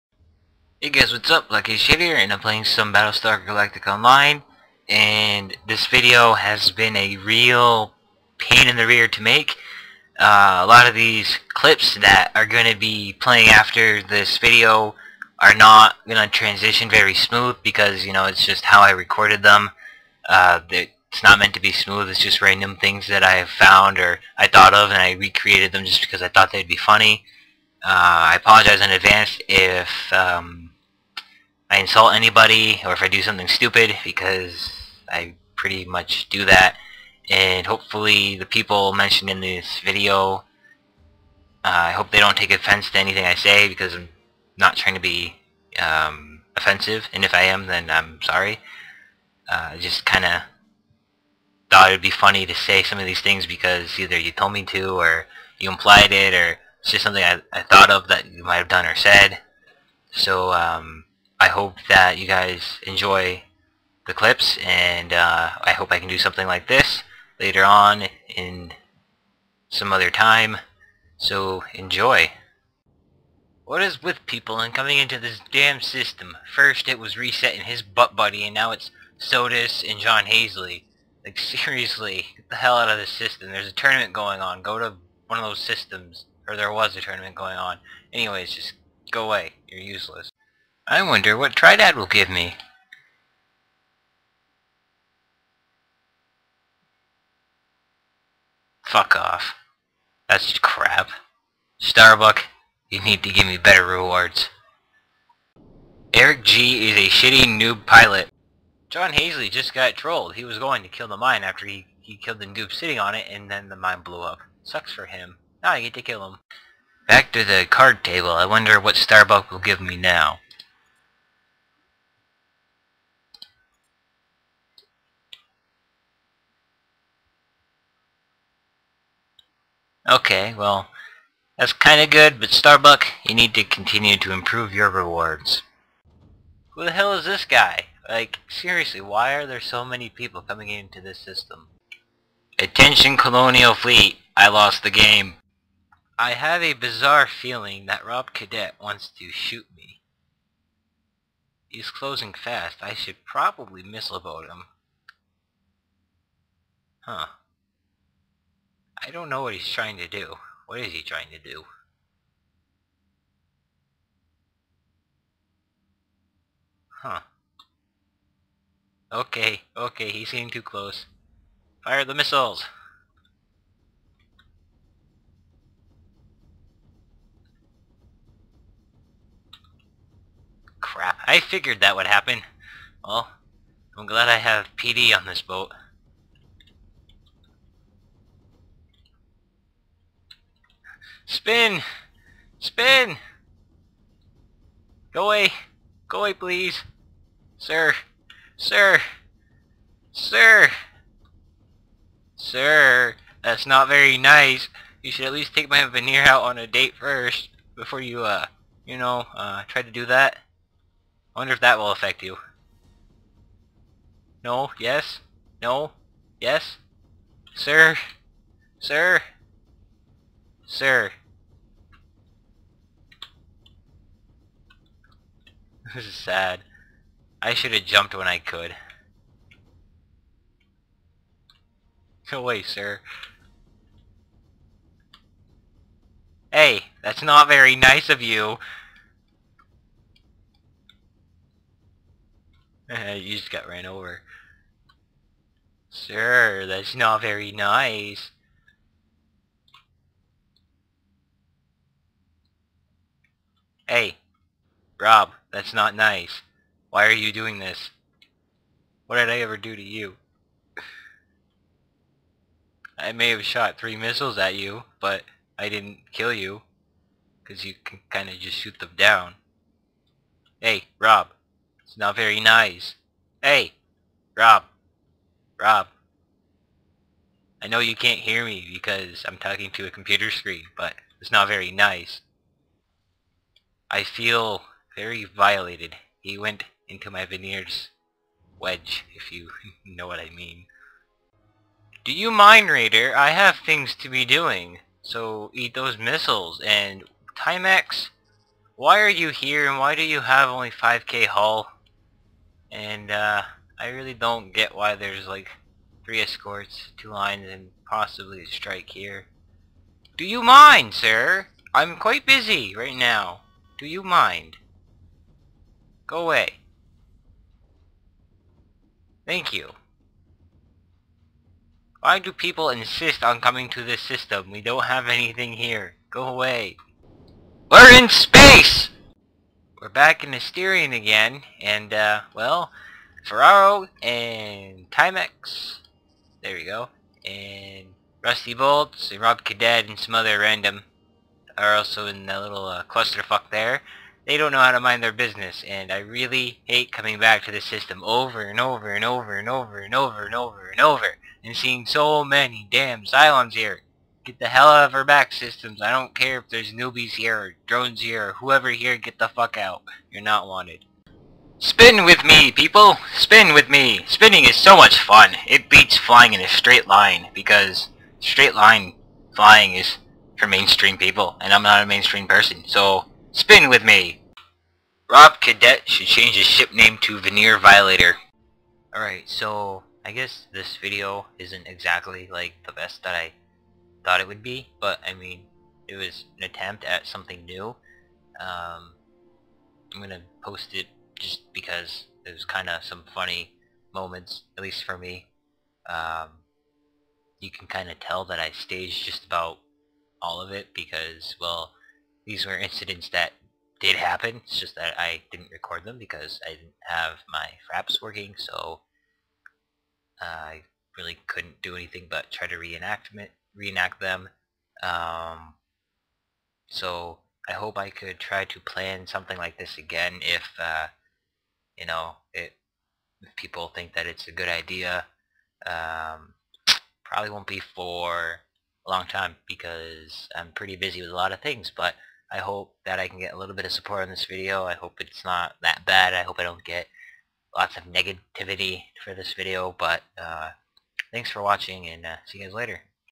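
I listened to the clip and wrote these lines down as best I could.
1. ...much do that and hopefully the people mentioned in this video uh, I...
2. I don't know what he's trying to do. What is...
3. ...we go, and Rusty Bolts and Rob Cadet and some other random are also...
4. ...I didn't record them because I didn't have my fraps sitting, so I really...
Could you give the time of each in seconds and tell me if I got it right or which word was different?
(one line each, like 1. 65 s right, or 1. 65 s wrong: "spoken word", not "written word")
1. 35 s right
2. 159 s right
3. 336 s right
4. 404 s wrong: "working", not "sitting".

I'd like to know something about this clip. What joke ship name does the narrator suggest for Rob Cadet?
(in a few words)
Veneer Violator.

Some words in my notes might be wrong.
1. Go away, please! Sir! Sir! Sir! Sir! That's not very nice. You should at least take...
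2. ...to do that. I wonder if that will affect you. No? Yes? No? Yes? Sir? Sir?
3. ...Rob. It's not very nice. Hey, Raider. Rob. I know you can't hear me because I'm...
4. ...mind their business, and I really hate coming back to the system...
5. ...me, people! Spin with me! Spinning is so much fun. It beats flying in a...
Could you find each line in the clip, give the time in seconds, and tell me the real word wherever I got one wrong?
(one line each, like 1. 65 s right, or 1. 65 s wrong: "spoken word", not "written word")
1. 196 s right
2. 209 s right
3. 270 s wrong: "Rob", not "Raider"
4. 344 s right
5. 362 s right.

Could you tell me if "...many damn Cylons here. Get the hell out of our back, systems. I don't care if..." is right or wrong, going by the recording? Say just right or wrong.
right.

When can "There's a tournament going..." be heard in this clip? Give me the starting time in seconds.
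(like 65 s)
83 s.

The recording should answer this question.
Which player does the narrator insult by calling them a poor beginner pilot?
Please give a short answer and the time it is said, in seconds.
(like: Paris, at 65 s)
Eric G, at 106 s.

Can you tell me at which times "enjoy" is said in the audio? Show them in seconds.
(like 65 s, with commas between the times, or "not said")
62 s, 71 s.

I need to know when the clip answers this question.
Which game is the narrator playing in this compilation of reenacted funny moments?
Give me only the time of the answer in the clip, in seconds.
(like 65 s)
2 s.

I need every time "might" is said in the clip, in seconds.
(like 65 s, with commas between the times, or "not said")
58 s.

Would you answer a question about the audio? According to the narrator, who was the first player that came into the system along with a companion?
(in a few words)
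Reset.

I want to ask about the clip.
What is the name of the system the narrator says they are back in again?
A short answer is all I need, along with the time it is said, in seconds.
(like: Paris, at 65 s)
Asterion, at 330 s.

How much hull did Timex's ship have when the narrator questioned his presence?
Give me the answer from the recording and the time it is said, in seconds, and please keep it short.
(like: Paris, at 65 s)
5k, at 300 s.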